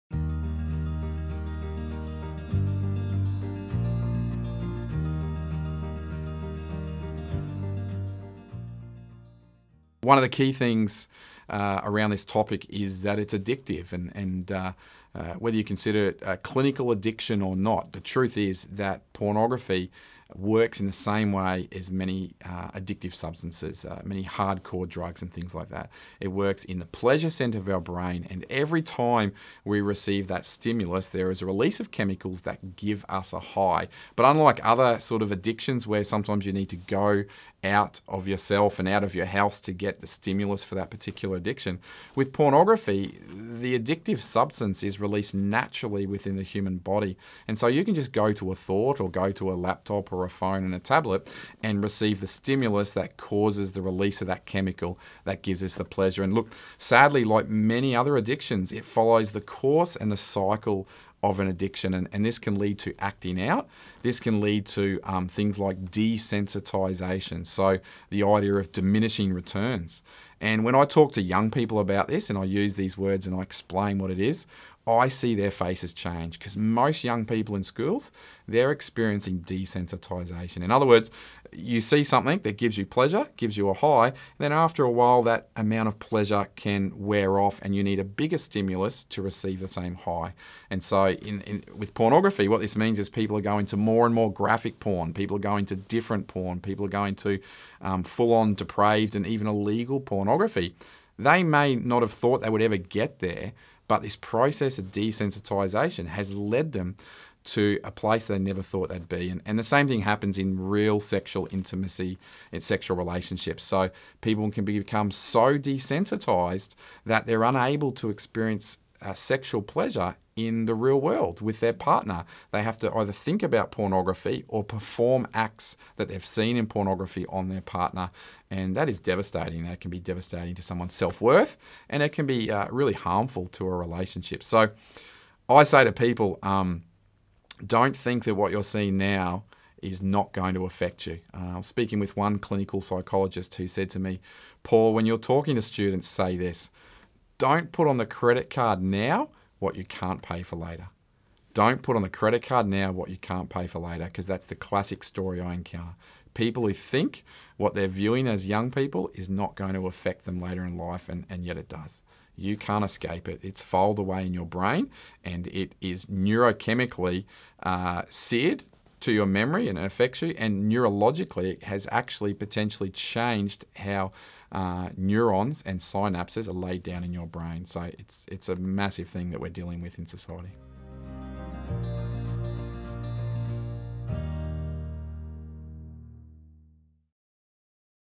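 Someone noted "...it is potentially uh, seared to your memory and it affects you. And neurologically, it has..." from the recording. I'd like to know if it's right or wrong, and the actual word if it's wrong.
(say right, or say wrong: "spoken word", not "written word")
wrong: "neurochemically", not "potentially".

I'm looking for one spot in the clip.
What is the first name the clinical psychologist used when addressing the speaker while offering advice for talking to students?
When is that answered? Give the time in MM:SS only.
02:24.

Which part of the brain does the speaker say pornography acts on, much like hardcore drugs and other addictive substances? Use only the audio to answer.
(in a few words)
pleasure center.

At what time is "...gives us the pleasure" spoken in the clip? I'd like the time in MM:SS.
00:55.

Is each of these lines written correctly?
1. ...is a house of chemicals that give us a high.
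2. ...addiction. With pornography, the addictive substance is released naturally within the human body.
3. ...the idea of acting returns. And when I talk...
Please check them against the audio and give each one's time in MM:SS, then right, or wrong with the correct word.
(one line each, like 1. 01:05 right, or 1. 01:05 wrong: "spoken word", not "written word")
1. 00:31 wrong: "release", not "house"
2. 00:41 right
3. 01:08 wrong: "diminishing", not "acting".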